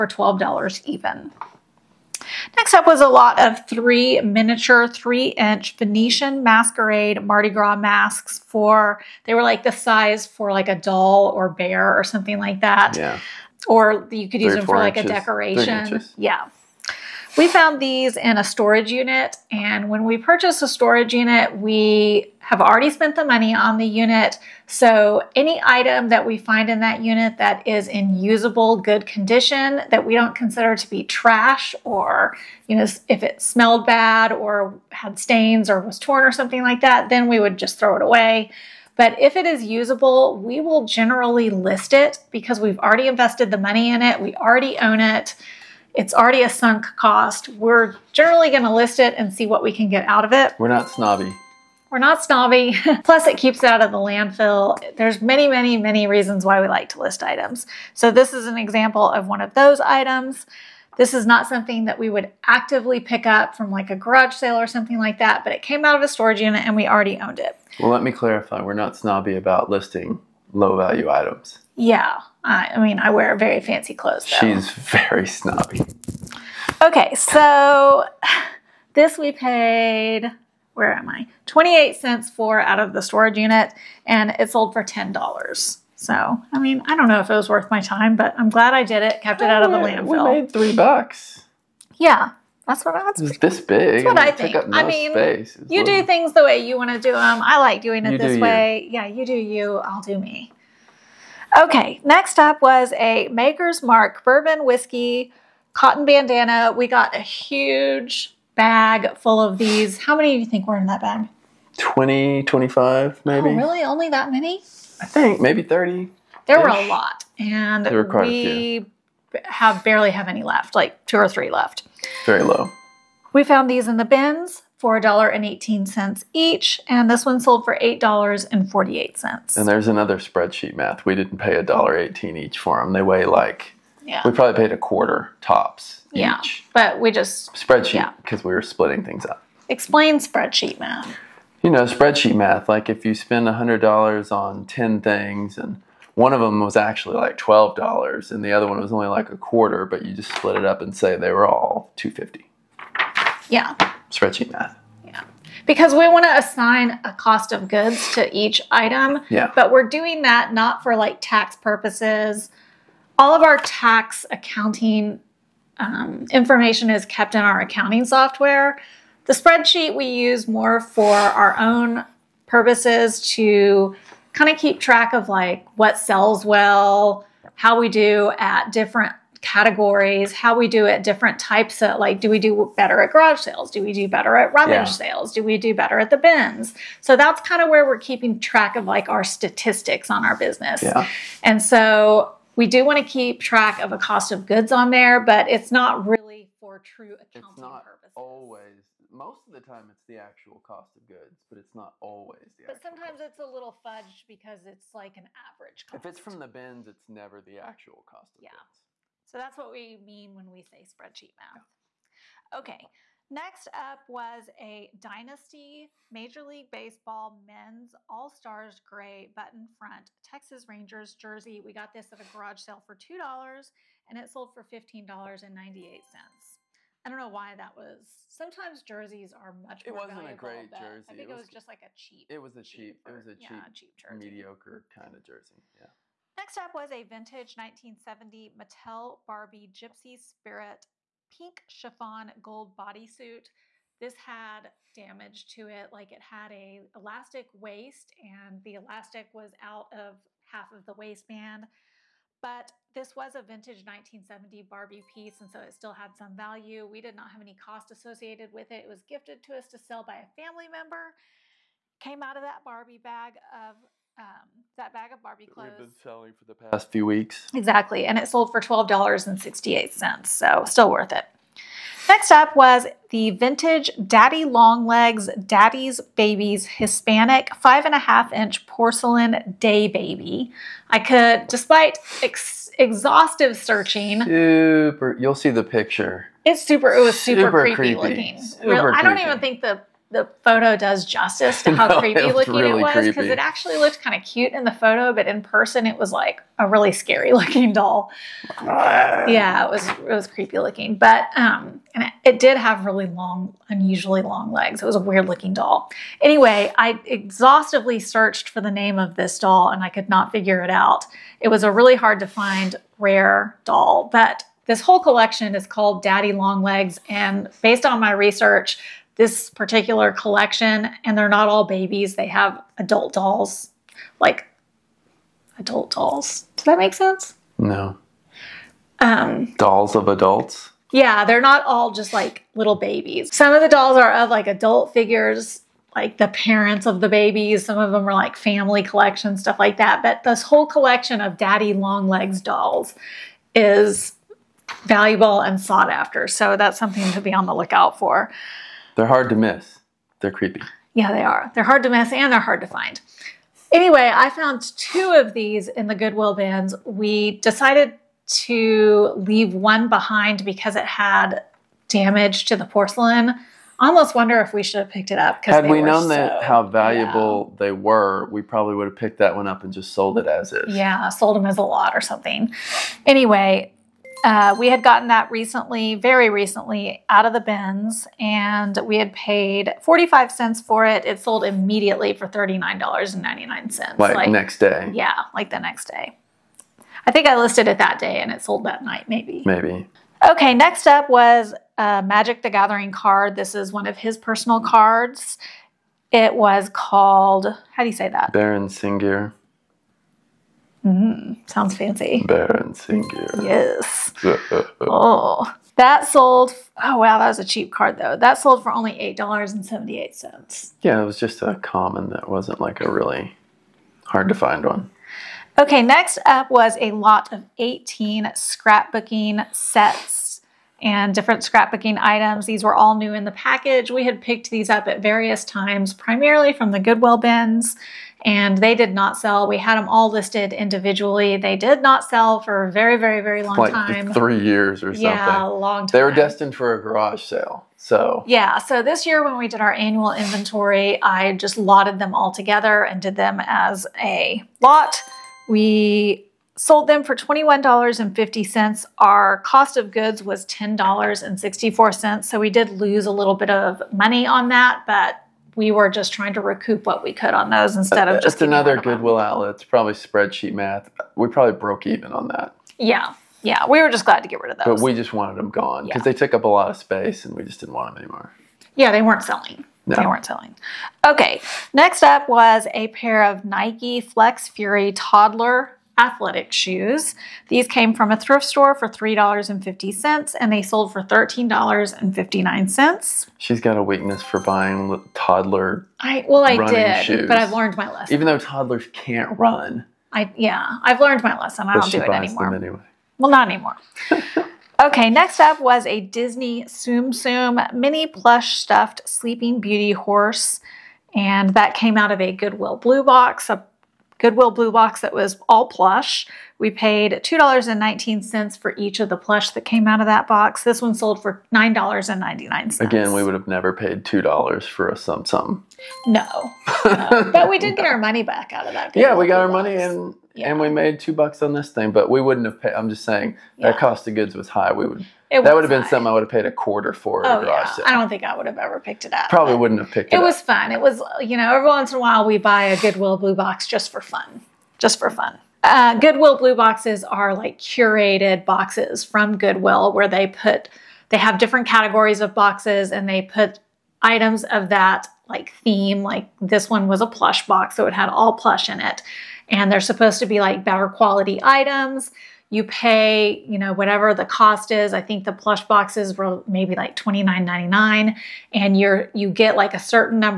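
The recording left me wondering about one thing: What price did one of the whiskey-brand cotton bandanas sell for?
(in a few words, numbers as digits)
$8.48.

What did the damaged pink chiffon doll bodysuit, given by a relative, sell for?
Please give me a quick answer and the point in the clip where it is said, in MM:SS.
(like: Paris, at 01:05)
$12.68, at 04:28.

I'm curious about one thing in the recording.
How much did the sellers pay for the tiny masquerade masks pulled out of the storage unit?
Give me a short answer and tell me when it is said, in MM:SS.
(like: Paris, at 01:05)
28 cents, at 01:21.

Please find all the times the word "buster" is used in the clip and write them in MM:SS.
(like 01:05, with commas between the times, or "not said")
not said.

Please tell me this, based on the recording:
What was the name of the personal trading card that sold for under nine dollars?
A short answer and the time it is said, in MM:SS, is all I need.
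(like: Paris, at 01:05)
Baron Sengir, at 06:38.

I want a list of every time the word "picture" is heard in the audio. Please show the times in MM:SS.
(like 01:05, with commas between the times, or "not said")
04:45.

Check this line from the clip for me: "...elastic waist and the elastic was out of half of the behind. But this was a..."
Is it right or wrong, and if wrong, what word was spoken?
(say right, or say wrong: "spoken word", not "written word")
wrong: "waistband", not "behind".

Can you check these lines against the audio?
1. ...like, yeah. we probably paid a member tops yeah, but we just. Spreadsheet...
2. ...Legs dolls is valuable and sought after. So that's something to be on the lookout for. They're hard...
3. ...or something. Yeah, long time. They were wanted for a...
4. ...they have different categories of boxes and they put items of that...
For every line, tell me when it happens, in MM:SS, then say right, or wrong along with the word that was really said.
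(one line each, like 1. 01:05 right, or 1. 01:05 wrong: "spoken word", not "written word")
1. 02:13 wrong: "quarter", not "member"
2. 05:42 right
3. 07:14 wrong: "destined", not "wanted"
4. 09:01 right.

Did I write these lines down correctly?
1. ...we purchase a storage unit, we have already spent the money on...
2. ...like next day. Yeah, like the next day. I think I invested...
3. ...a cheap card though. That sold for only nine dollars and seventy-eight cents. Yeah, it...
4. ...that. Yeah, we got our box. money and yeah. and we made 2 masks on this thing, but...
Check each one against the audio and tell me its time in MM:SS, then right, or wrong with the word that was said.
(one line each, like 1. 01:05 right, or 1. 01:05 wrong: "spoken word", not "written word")
1. 00:20 right
2. 06:24 wrong: "listed", not "invested"
3. 06:47 wrong: "eight", not "nine"
4. 08:38 wrong: "bucks", not "masks".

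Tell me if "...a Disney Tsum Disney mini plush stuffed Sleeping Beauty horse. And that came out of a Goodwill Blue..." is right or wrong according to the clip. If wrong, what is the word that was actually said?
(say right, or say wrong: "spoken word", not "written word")
wrong: "Tsum", not "Disney".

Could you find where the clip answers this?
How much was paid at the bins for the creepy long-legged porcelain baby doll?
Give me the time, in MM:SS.
06:19.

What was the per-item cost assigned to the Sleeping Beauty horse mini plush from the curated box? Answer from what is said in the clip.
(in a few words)
$2.19.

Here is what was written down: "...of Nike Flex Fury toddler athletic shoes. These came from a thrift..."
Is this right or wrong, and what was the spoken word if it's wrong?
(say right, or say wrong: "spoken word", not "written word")
right.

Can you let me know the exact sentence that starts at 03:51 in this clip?
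I think it was, it was, just like a cheap.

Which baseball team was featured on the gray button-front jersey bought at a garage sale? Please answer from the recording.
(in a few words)
Texas Rangers.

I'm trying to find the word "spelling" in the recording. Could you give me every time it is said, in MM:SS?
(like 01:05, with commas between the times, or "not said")
not said.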